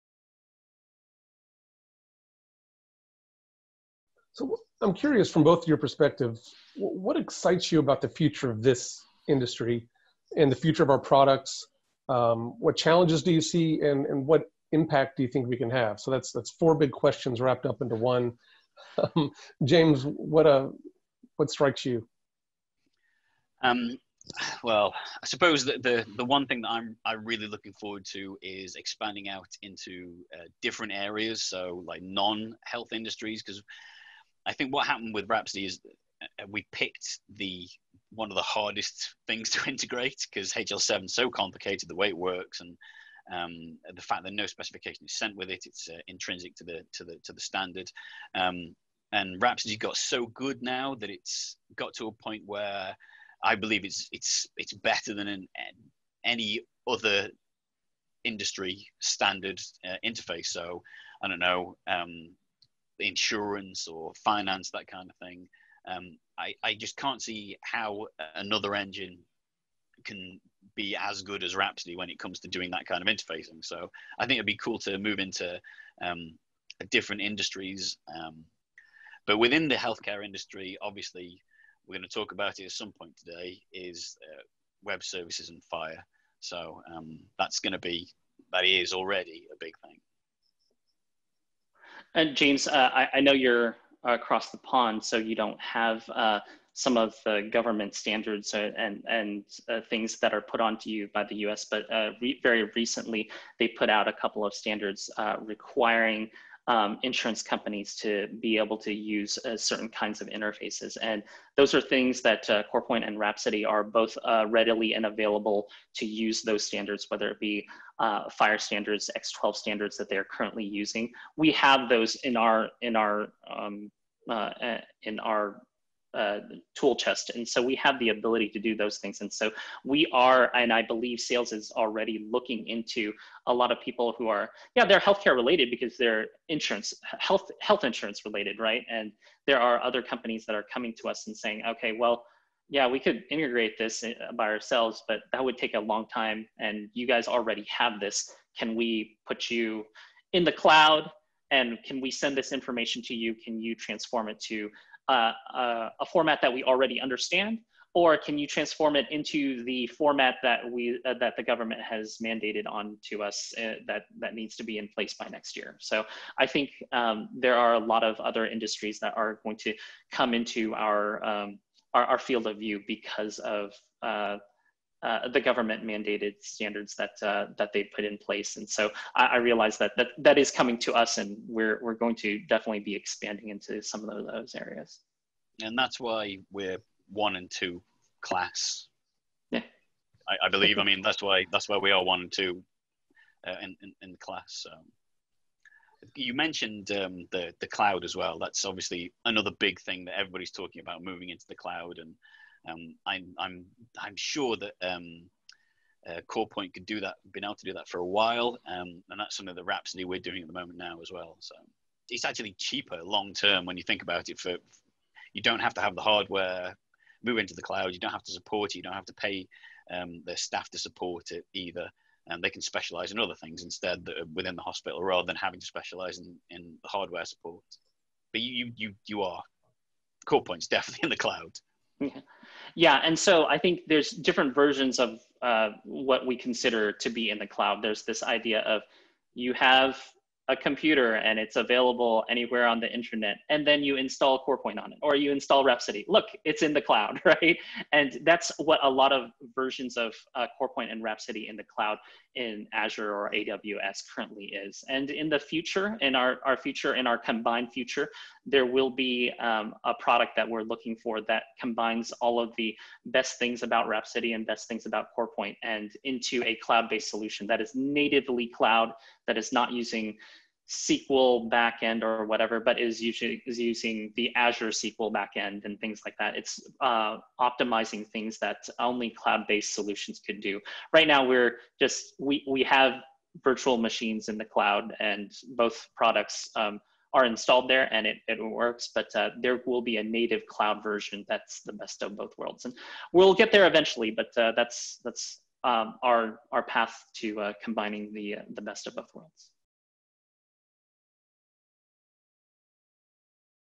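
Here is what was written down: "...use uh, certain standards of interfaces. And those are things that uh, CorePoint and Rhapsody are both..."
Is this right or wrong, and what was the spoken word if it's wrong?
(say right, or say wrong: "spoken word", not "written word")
wrong: "kinds", not "standards".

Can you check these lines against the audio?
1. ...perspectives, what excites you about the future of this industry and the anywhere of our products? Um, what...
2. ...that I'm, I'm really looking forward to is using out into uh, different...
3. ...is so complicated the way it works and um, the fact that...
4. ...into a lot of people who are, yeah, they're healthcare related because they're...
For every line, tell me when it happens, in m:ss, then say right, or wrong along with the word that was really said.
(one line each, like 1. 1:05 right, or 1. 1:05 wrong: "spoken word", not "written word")
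1. 0:05 wrong: "future", not "anywhere"
2. 0:26 wrong: "expanding", not "using"
3. 0:41 right
4. 2:12 right.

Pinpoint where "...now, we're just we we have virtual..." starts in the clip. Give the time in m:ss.
4:41.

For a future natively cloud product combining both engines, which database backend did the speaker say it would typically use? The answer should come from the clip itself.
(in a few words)
Azure SQL.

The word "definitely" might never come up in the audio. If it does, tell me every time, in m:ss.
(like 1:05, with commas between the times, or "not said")
3:02, 3:50.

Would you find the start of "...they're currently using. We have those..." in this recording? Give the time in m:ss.
2:00.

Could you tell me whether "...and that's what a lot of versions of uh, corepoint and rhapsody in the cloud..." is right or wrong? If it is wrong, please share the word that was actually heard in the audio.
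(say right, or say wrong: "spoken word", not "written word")
right.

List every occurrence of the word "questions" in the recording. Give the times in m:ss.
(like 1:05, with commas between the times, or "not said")
0:16.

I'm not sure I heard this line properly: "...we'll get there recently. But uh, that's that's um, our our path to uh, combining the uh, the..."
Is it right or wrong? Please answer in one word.
wrong.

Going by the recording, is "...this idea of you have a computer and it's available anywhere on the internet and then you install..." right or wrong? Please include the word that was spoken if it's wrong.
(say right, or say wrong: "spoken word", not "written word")
right.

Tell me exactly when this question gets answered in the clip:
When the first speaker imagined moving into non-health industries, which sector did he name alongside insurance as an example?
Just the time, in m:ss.
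1:04.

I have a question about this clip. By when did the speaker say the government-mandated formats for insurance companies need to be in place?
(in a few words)
Next year.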